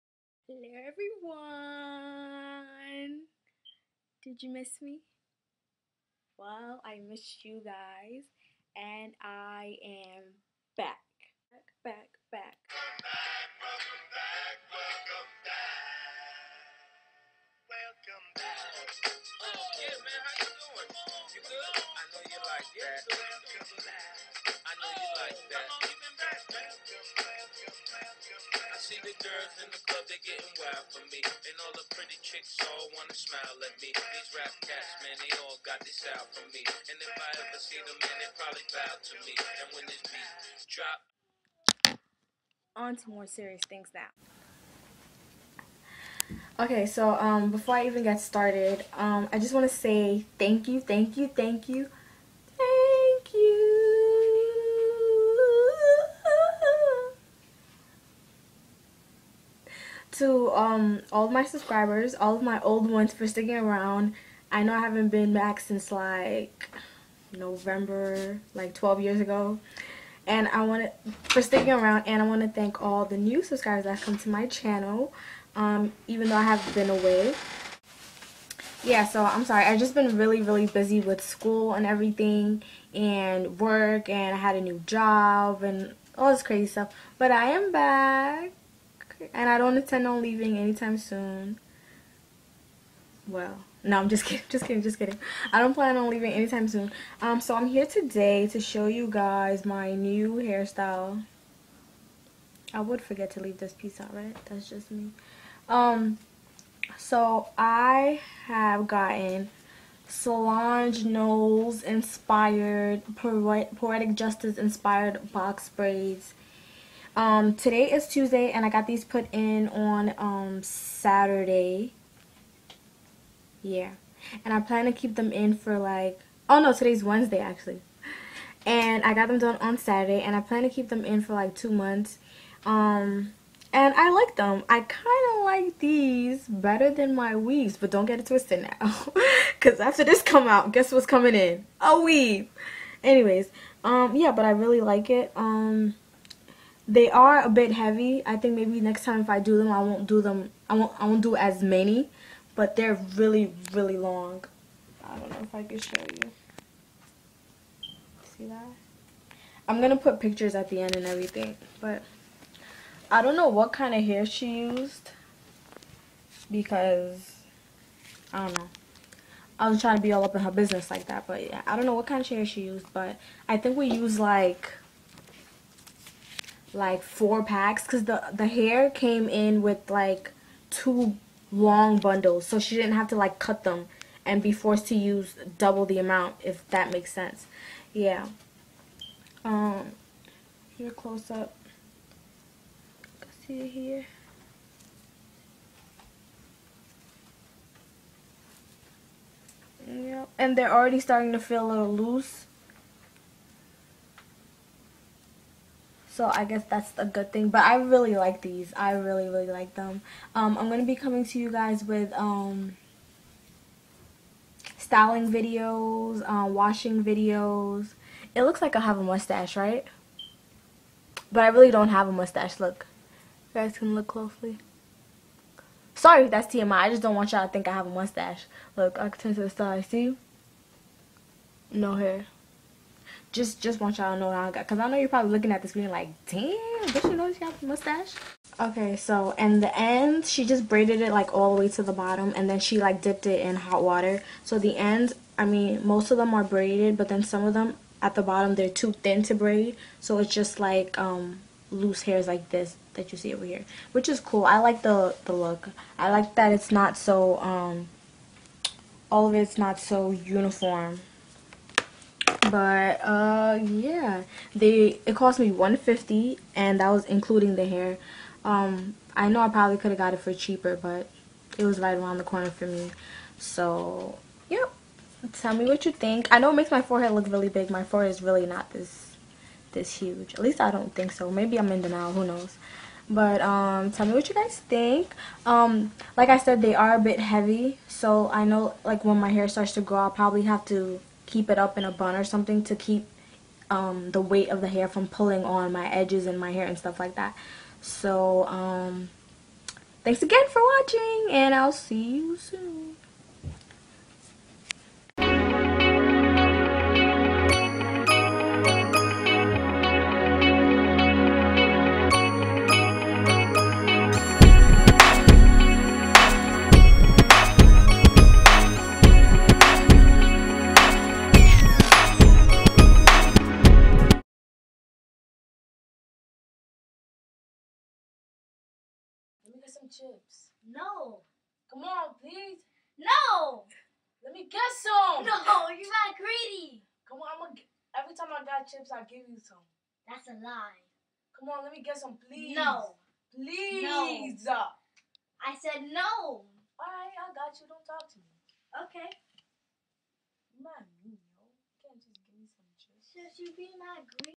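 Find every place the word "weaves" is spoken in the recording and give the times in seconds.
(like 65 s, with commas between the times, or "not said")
137 s, 141 s.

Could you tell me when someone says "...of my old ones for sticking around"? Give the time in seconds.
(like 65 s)
62 s.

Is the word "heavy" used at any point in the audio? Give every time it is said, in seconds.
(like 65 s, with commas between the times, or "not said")
147 s, 287 s.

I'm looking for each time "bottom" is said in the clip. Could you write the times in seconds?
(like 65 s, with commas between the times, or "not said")
241 s, 248 s.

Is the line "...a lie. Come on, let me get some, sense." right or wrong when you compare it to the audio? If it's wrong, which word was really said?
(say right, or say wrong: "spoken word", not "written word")
wrong: "please", not "sense".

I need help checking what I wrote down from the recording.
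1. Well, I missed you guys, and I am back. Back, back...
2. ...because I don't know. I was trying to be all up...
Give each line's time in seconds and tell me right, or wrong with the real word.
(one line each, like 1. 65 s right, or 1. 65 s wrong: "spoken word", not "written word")
1. 6 s right
2. 166 s right.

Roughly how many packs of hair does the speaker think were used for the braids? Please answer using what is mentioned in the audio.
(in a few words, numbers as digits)
4.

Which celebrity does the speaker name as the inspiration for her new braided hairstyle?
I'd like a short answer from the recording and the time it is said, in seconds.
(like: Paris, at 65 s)
Solange Knowles, at 110 s.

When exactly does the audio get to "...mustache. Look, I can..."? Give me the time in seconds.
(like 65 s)
227 s.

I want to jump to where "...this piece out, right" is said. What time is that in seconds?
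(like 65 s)
103 s.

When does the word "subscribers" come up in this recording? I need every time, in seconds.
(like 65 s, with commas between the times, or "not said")
61 s, 73 s.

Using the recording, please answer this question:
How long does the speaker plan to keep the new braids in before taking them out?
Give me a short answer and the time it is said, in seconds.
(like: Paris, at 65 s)
2 months, at 131 s.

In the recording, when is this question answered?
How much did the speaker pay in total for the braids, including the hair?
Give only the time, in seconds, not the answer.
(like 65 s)
265 s.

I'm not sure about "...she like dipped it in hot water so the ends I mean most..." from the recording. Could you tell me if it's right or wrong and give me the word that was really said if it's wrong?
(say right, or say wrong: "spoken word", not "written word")
right.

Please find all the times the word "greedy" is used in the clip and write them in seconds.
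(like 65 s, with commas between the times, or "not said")
336 s, 354 s.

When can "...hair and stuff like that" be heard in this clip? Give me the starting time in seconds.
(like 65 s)
296 s.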